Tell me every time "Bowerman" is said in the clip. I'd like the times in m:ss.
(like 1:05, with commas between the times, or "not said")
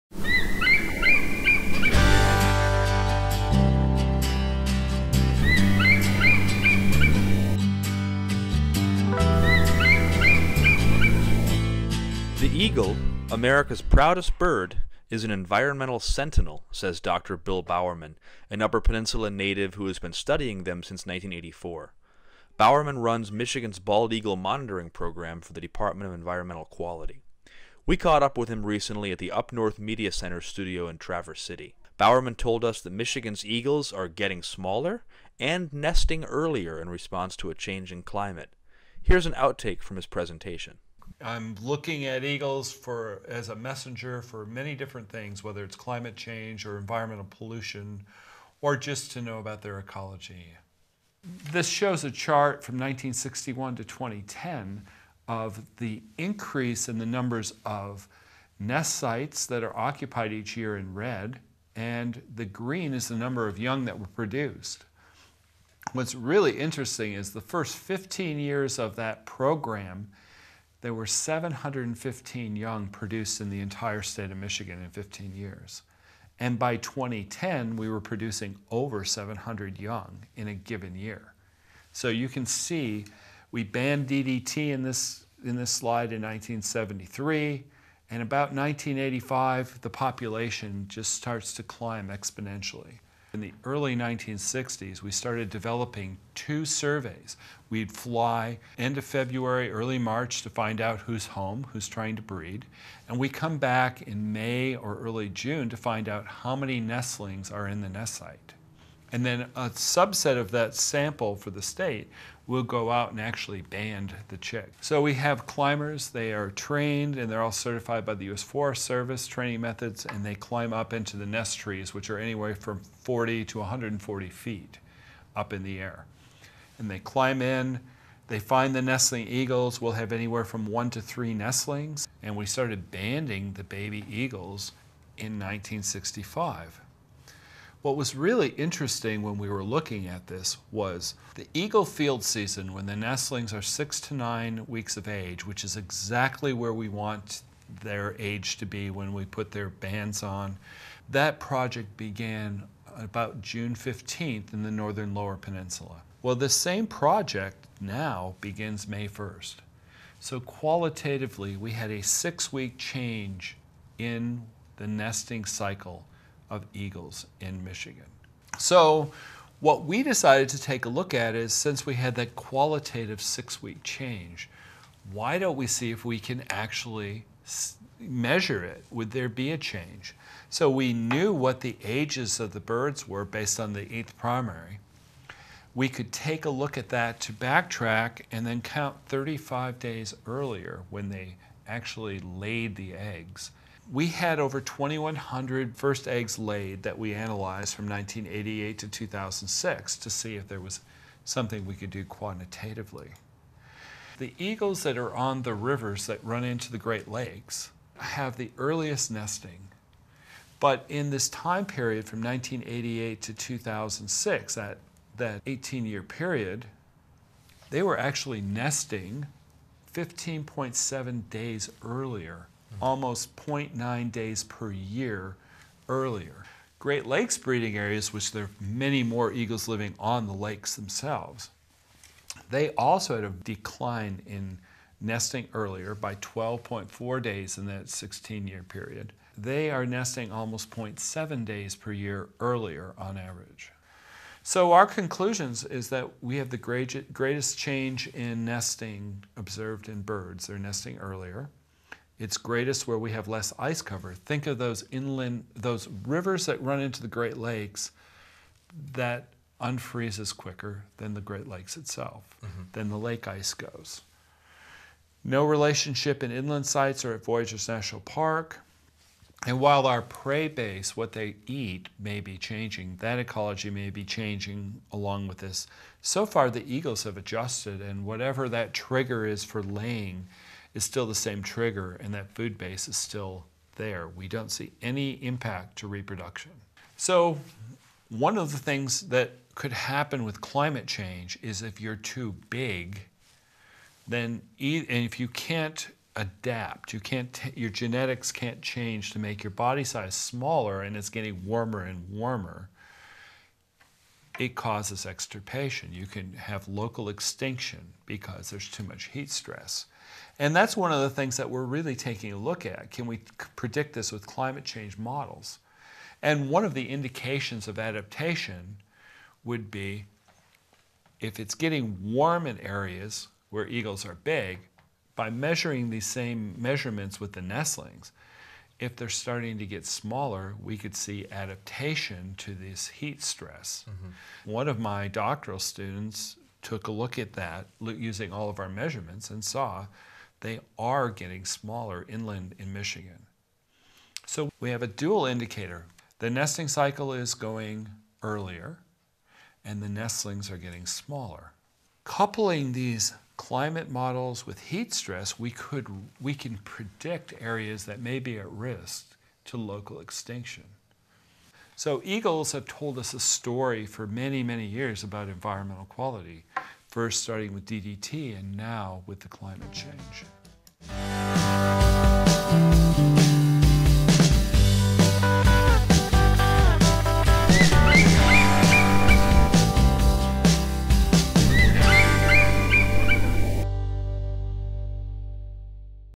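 0:17, 0:22, 0:31.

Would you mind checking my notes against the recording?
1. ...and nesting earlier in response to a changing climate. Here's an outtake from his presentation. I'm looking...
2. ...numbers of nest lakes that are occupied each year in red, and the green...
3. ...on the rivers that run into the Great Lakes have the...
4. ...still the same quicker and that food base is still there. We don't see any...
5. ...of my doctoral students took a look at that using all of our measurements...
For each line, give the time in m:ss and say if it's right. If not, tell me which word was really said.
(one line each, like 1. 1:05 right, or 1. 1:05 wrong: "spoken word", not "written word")
1. 0:35 right
2. 0:57 wrong: "sites", not "lakes"
3. 3:25 right
4. 4:40 wrong: "trigger", not "quicker"
5. 5:34 right.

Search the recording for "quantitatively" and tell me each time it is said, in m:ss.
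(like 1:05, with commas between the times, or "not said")
3:22.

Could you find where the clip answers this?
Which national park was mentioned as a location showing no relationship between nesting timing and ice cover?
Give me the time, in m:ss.
4:27.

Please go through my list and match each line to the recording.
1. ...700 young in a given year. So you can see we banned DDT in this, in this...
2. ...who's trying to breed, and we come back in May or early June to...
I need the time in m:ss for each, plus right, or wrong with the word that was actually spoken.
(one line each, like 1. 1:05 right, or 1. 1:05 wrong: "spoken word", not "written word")
1. 1:19 right
2. 1:41 right.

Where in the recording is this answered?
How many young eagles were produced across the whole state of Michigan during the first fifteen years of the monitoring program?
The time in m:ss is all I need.
1:11.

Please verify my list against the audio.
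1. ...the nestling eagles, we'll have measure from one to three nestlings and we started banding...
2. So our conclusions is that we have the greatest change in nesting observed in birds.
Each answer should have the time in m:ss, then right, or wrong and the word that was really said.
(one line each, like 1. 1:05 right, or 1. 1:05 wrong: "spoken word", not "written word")
1. 2:08 wrong: "anywhere", not "measure"
2. 4:04 right.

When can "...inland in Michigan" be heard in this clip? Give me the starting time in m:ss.
5:42.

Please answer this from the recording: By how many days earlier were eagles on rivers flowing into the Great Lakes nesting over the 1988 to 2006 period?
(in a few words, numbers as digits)
15.7 days.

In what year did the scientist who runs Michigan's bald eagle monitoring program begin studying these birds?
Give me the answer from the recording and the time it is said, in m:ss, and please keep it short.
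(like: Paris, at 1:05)
1984, at 0:21.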